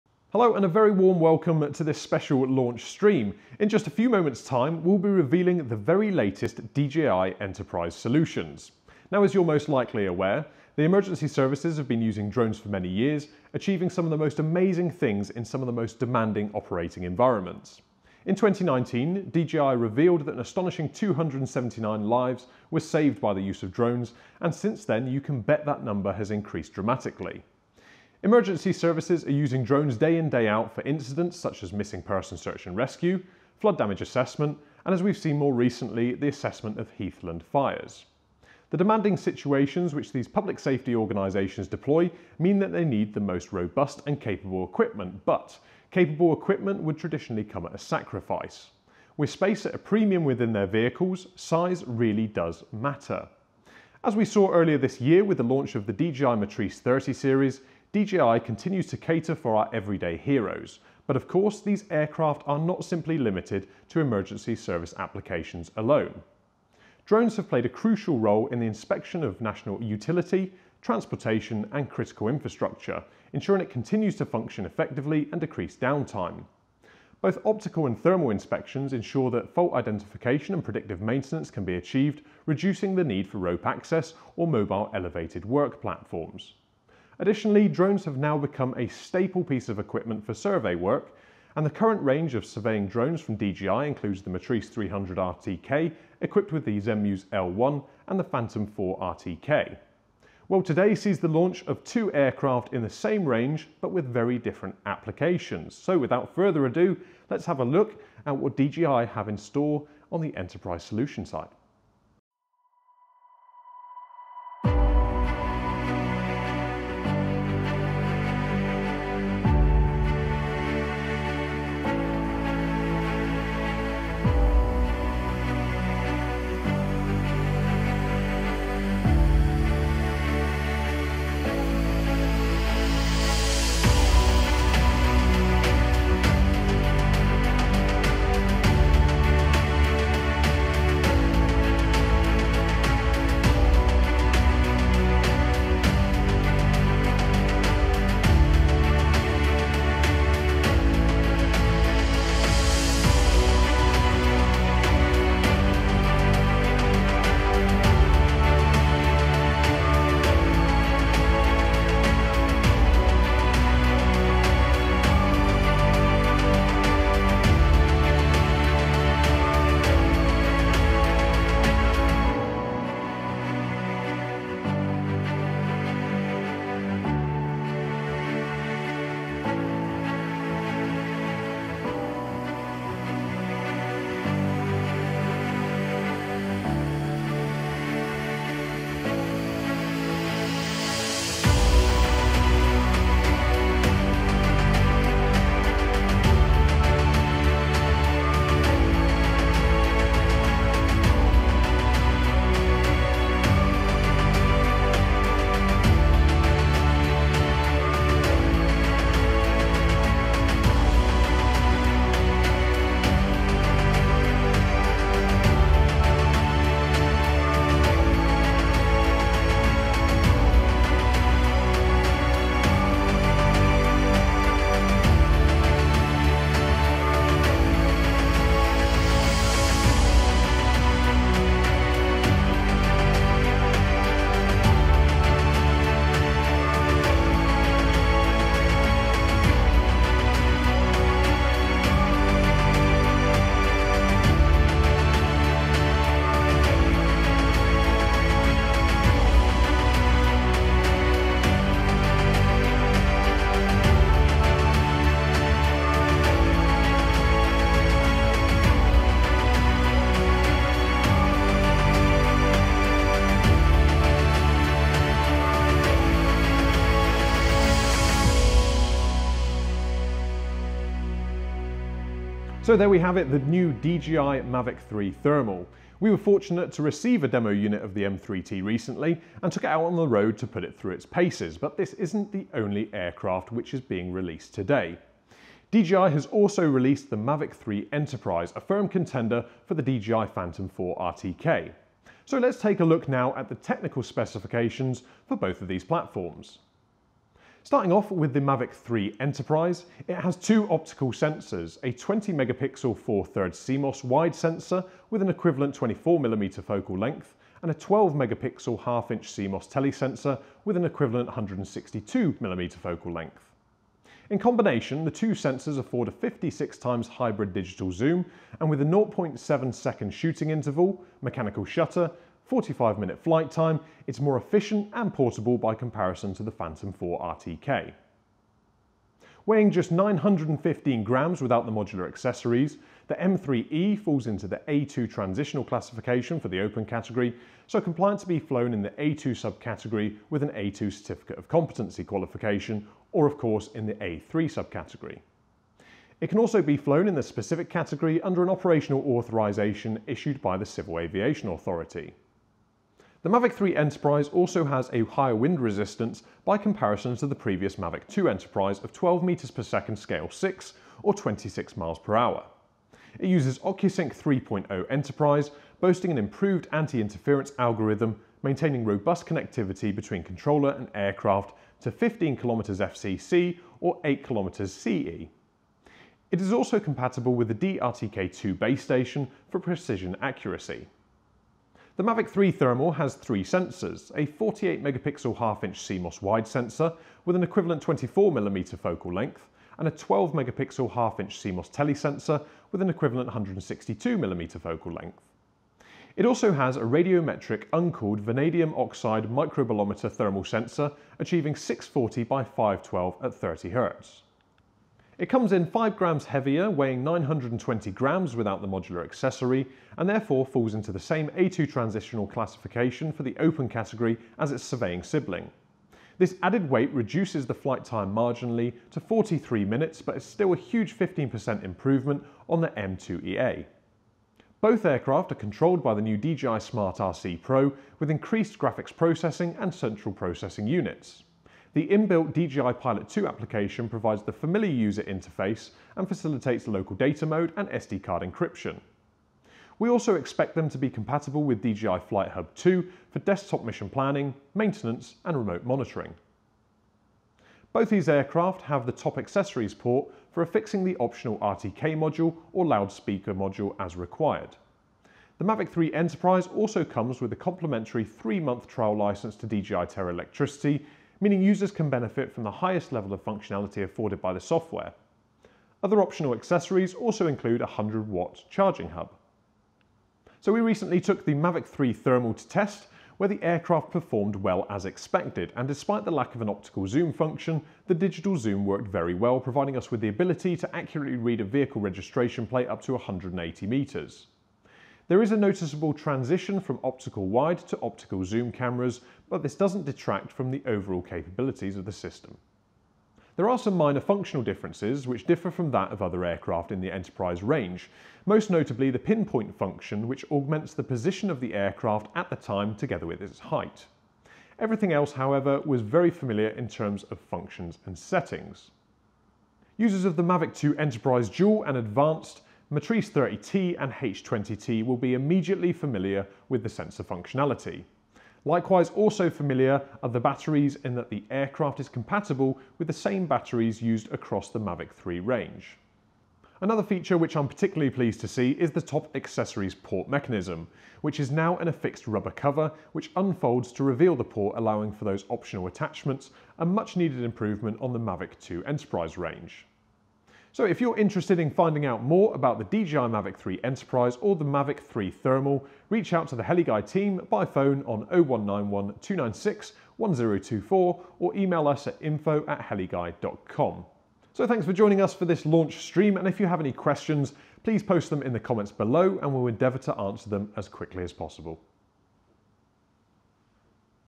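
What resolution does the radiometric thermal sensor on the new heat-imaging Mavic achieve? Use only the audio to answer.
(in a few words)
640 by 512.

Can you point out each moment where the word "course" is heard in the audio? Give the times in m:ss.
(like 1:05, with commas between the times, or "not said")
1:01, 5:43.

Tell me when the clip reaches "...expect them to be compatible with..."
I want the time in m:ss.
7:20.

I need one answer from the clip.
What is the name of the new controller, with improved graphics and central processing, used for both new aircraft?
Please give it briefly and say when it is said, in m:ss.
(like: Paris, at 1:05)
DJI Smart RC Pro, at 7:06.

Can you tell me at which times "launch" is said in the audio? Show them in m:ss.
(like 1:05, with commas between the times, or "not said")
0:02, 0:55, 1:41, 9:15.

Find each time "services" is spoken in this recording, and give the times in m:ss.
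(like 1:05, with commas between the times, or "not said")
0:11, 0:28, 1:04.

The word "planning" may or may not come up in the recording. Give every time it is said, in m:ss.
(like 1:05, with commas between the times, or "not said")
7:23.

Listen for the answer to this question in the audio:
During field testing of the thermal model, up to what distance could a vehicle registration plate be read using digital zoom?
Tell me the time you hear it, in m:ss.
8:02.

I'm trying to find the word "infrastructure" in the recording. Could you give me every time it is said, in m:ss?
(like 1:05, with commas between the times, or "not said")
1:12.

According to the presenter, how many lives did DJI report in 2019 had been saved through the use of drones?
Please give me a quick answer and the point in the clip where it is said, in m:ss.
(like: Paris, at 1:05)
279, at 0:20.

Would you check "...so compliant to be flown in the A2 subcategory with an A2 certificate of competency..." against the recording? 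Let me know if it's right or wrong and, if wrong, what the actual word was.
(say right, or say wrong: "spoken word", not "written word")
right.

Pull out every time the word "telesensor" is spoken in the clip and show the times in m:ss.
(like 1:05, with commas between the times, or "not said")
5:09, 6:31.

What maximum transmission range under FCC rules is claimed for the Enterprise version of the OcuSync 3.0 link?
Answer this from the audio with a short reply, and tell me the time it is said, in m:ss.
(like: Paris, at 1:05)
15 kilometers, at 6:11.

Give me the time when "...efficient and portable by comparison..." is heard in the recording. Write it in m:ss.
5:24.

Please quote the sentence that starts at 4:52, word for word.
So let's take a look now at the technical specifications for both of these platforms.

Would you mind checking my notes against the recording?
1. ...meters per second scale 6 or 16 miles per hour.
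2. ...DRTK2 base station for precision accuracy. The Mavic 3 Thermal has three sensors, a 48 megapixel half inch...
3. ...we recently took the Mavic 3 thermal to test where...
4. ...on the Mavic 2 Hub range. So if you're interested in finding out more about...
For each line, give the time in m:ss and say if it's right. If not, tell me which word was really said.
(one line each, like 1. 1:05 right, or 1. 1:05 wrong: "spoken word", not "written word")
1. 5:59 wrong: "26", not "16"
2. 6:17 right
3. 7:50 right
4. 8:57 wrong: "Enterprise", not "Hub".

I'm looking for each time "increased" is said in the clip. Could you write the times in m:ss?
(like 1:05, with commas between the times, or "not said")
0:26, 7:08.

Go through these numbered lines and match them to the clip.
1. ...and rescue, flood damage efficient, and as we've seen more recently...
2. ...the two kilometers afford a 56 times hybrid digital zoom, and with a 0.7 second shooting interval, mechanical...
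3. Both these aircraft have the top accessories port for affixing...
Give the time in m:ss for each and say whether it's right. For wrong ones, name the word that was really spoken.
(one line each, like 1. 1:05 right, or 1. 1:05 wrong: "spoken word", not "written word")
1. 0:32 wrong: "assessment", not "efficient"
2. 5:15 wrong: "sensors", not "kilometers"
3. 7:27 right.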